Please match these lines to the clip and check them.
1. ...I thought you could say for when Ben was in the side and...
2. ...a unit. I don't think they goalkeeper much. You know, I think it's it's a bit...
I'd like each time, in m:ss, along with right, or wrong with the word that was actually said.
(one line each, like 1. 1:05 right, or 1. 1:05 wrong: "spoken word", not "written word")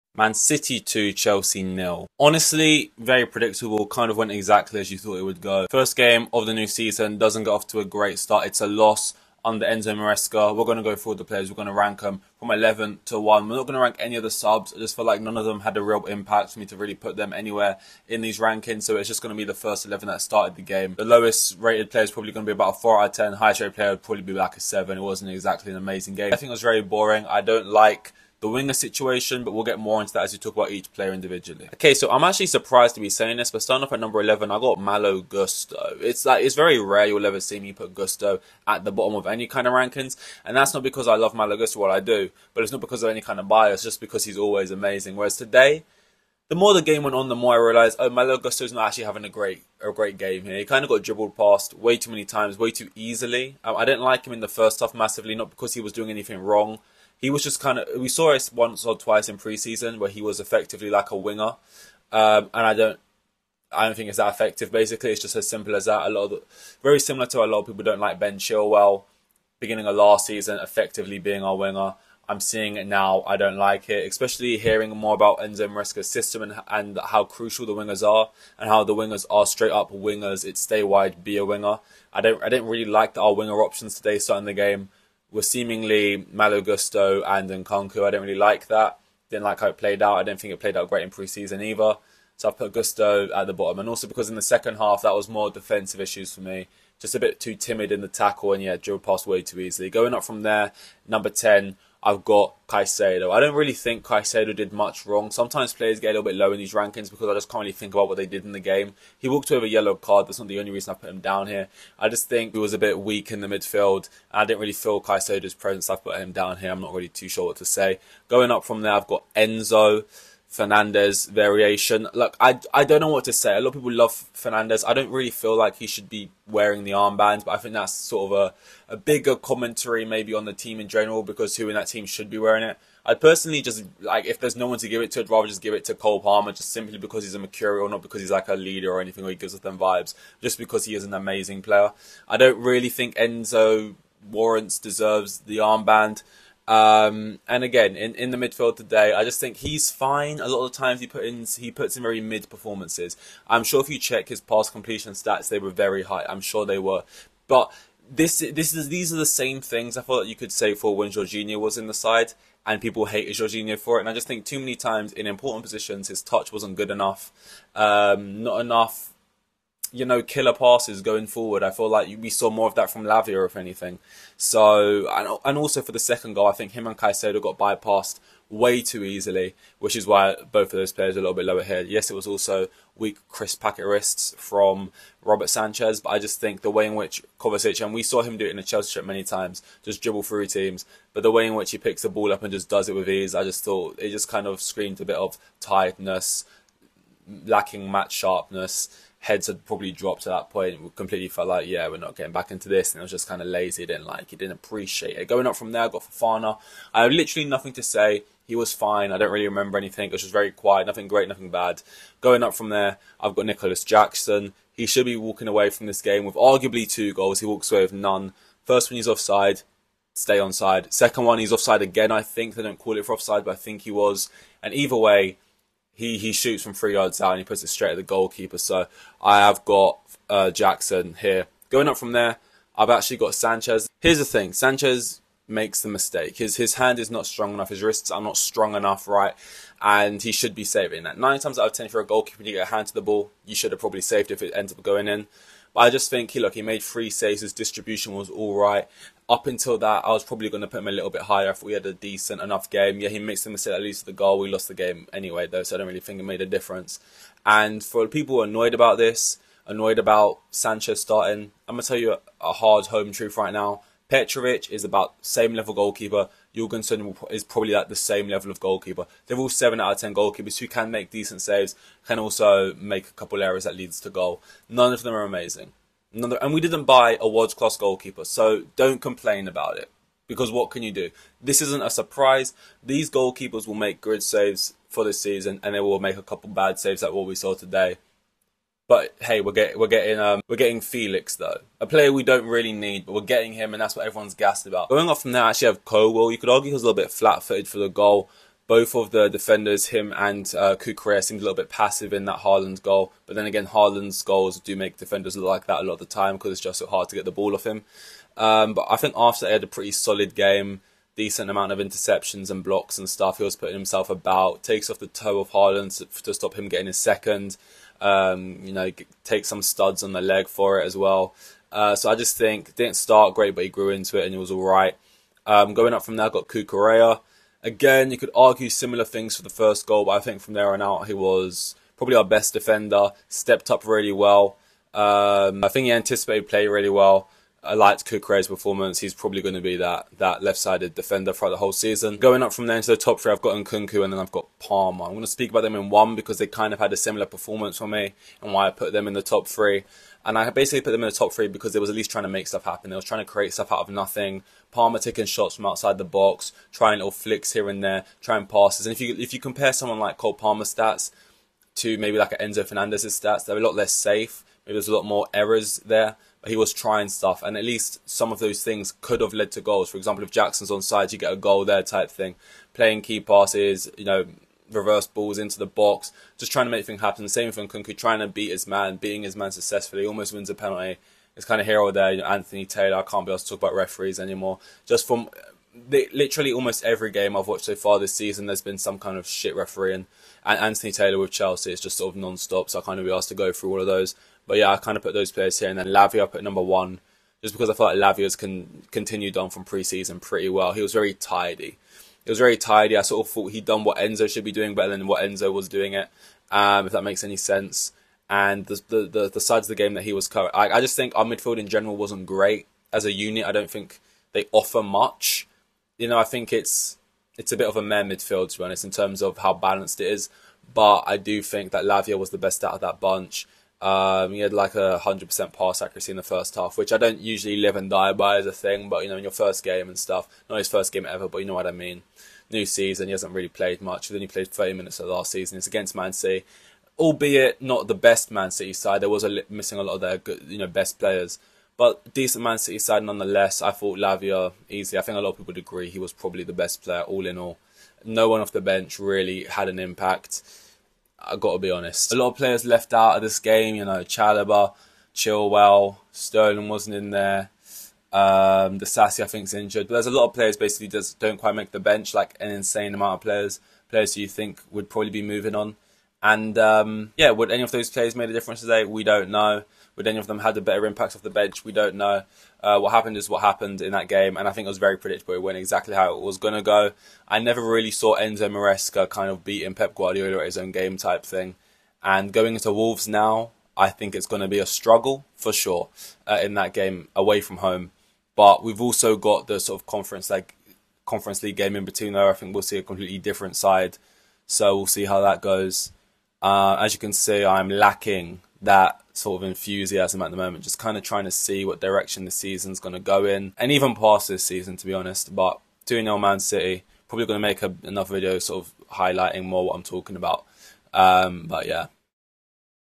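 1. 2:39 wrong: "Jorginho", not "Ben"
2. 6:53 wrong: "offer", not "goalkeeper".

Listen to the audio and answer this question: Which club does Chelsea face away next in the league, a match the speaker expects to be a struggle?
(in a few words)
Wolves.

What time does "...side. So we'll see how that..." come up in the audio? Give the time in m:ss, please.
8:13.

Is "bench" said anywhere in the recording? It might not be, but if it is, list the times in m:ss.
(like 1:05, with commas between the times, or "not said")
7:28, 7:41, 7:51.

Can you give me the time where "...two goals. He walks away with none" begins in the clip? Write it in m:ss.
3:36.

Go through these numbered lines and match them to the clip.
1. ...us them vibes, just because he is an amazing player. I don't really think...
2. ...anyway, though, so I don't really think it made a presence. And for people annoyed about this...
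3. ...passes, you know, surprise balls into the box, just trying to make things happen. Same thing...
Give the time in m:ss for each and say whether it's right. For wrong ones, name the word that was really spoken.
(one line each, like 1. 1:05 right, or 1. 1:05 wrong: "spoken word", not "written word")
1. 2:19 right
2. 4:15 wrong: "difference", not "presence"
3. 6:13 wrong: "reverse", not "surprise".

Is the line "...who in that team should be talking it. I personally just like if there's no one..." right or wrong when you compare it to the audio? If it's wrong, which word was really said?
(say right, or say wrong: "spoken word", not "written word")
wrong: "wearing", not "talking".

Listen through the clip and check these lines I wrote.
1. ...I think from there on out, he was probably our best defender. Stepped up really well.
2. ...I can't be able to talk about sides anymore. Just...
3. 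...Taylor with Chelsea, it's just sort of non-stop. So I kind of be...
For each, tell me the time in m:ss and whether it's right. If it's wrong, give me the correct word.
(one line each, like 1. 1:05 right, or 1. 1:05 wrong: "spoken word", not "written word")
1. 5:30 right
2. 6:22 wrong: "referees", not "sides"
3. 6:30 right.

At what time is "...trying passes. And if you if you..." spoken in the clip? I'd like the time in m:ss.
5:58.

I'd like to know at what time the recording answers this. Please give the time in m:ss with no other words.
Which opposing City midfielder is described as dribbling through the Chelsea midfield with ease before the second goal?
3:07.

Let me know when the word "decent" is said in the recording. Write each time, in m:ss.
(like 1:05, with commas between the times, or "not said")
4:11, 4:31, 5:11, 7:22.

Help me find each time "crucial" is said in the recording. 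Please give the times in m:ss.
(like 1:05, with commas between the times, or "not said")
1:17.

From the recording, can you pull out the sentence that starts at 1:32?
So I put Gusto at the bottom.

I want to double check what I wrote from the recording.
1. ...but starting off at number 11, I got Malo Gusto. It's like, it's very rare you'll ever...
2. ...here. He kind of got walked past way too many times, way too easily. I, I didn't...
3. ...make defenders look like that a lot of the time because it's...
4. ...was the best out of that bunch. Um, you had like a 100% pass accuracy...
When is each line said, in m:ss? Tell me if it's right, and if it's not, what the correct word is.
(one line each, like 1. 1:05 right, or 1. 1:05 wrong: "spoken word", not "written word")
1. 0:33 right
2. 0:50 wrong: "dribbled", not "walked"
3. 5:04 right
4. 7:02 right.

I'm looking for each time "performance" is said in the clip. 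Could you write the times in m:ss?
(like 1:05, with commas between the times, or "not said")
2:32, 5:38, 5:47.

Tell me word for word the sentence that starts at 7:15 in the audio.
It's against Man City, albeit not the best Man City side.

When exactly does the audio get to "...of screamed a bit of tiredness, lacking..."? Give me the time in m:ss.
3:14.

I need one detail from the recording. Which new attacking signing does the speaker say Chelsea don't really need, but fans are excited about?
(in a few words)
Felix.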